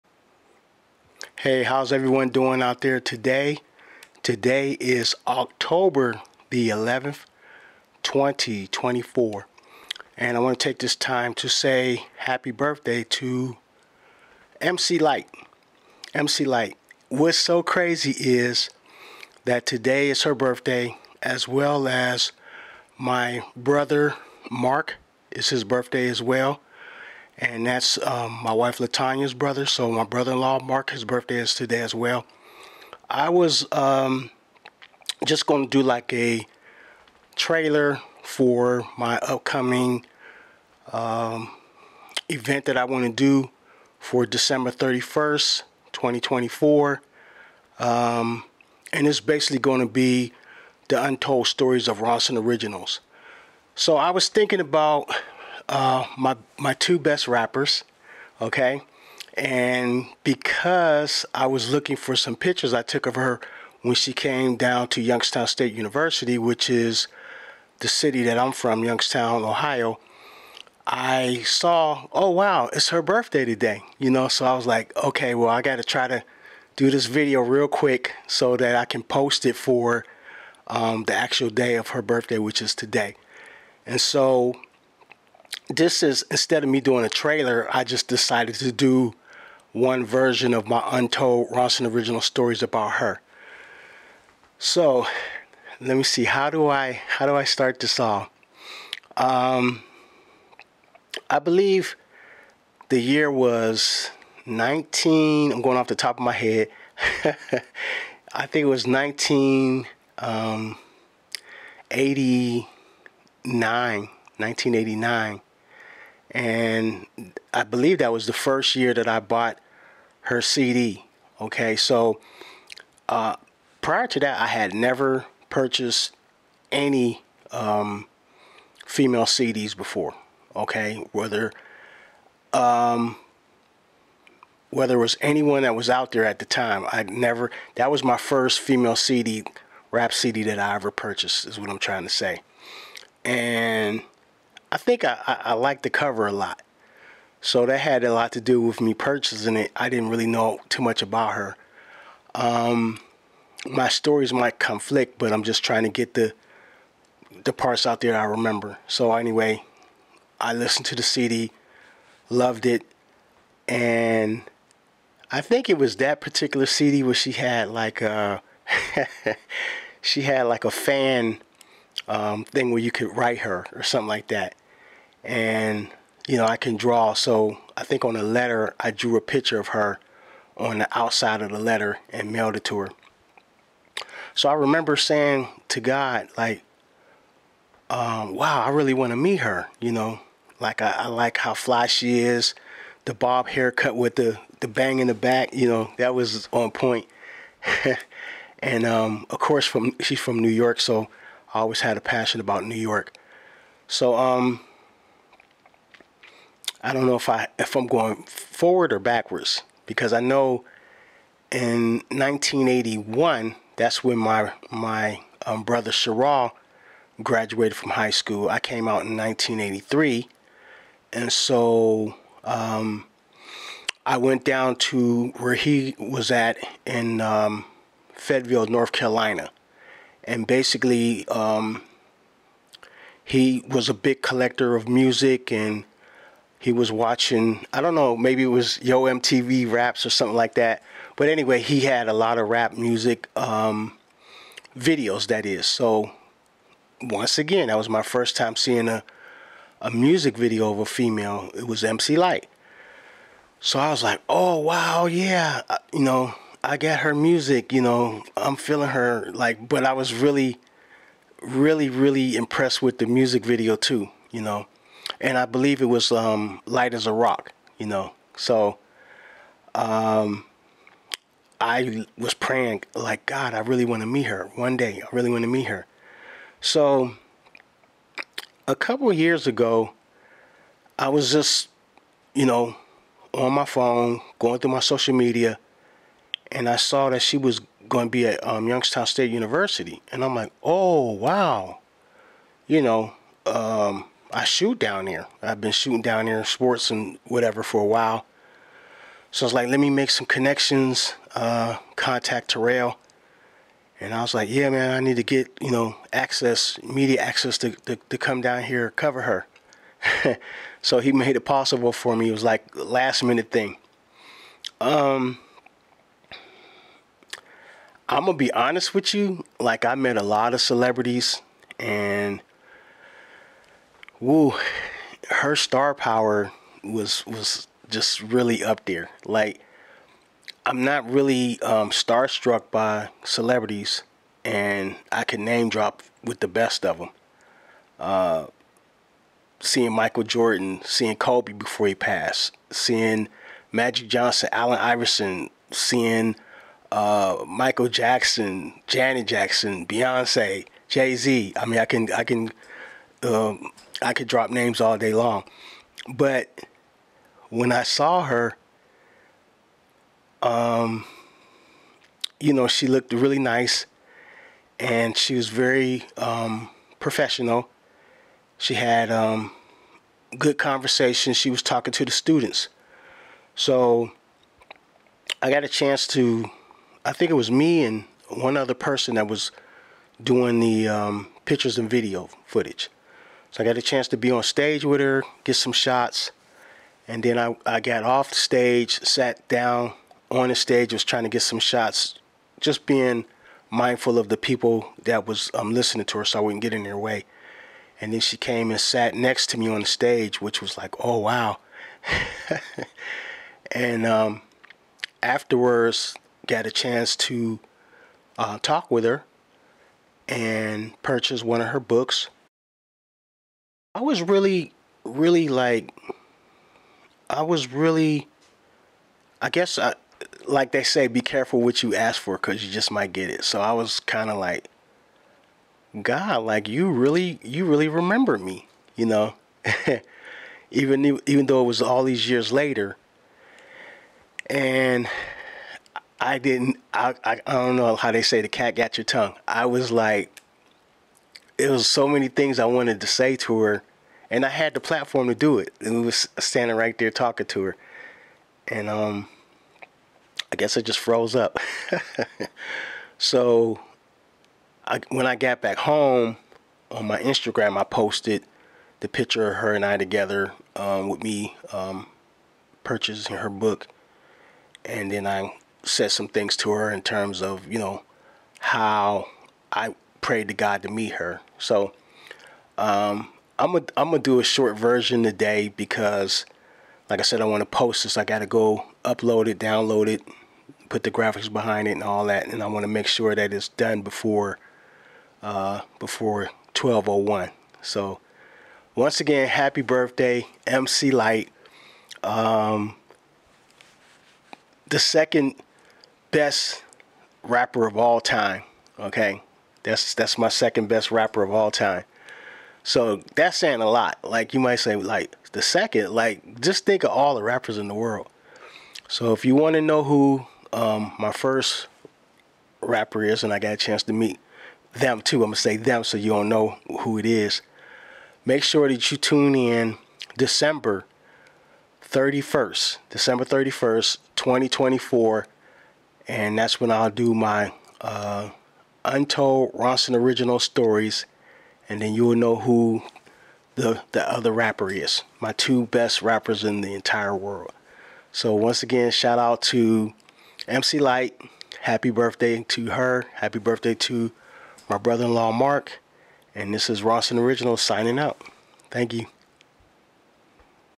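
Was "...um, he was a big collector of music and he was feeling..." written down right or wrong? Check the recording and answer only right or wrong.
wrong.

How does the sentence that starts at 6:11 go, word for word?
She was talking to the students.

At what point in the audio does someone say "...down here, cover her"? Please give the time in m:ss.
5:08.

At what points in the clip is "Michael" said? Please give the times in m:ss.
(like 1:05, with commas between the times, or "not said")
5:39, 5:47.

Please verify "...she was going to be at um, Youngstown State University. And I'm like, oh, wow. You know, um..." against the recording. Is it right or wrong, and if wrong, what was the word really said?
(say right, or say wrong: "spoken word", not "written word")
right.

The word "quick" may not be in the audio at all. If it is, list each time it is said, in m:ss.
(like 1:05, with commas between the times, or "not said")
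1:17.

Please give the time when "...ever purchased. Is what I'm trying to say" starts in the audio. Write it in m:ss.
2:20.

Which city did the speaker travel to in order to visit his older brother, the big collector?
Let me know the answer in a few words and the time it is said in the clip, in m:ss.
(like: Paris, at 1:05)
Fayetteville, North Carolina, at 3:48.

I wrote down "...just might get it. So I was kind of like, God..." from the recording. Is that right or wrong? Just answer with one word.
right.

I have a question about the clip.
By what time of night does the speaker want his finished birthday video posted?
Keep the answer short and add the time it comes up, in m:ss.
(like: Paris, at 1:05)
12:01, at 8:06.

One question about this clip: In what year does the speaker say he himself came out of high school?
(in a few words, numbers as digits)
1983.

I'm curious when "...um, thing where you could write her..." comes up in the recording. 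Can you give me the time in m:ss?
2:52.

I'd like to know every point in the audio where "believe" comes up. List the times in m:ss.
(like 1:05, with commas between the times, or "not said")
1:41, 1:57, 4:25.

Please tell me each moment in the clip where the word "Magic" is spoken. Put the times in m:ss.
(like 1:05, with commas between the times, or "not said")
5:43.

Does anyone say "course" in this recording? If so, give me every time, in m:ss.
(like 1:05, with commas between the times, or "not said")
3:19.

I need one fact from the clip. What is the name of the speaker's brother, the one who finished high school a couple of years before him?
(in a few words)
Sherrall.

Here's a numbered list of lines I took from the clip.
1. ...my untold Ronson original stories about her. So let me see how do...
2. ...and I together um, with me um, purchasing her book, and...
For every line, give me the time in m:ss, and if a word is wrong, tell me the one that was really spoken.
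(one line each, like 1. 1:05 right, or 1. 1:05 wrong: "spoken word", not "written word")
1. 1:30 right
2. 7:39 right.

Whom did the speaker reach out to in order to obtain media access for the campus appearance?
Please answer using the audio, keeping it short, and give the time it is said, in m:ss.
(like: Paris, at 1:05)
Terrell, at 5:02.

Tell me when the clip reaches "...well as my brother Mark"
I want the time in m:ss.
0:21.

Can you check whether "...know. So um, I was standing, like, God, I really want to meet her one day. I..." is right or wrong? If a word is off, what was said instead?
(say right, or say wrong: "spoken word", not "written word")
wrong: "praying", not "standing".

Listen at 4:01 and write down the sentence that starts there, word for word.
But anyway, he had a lot of rap music um, videos, that is.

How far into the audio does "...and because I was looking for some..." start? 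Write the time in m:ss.
0:59.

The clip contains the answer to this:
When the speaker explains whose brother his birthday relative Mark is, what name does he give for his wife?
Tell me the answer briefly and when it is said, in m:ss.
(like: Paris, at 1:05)
Latanya, at 0:28.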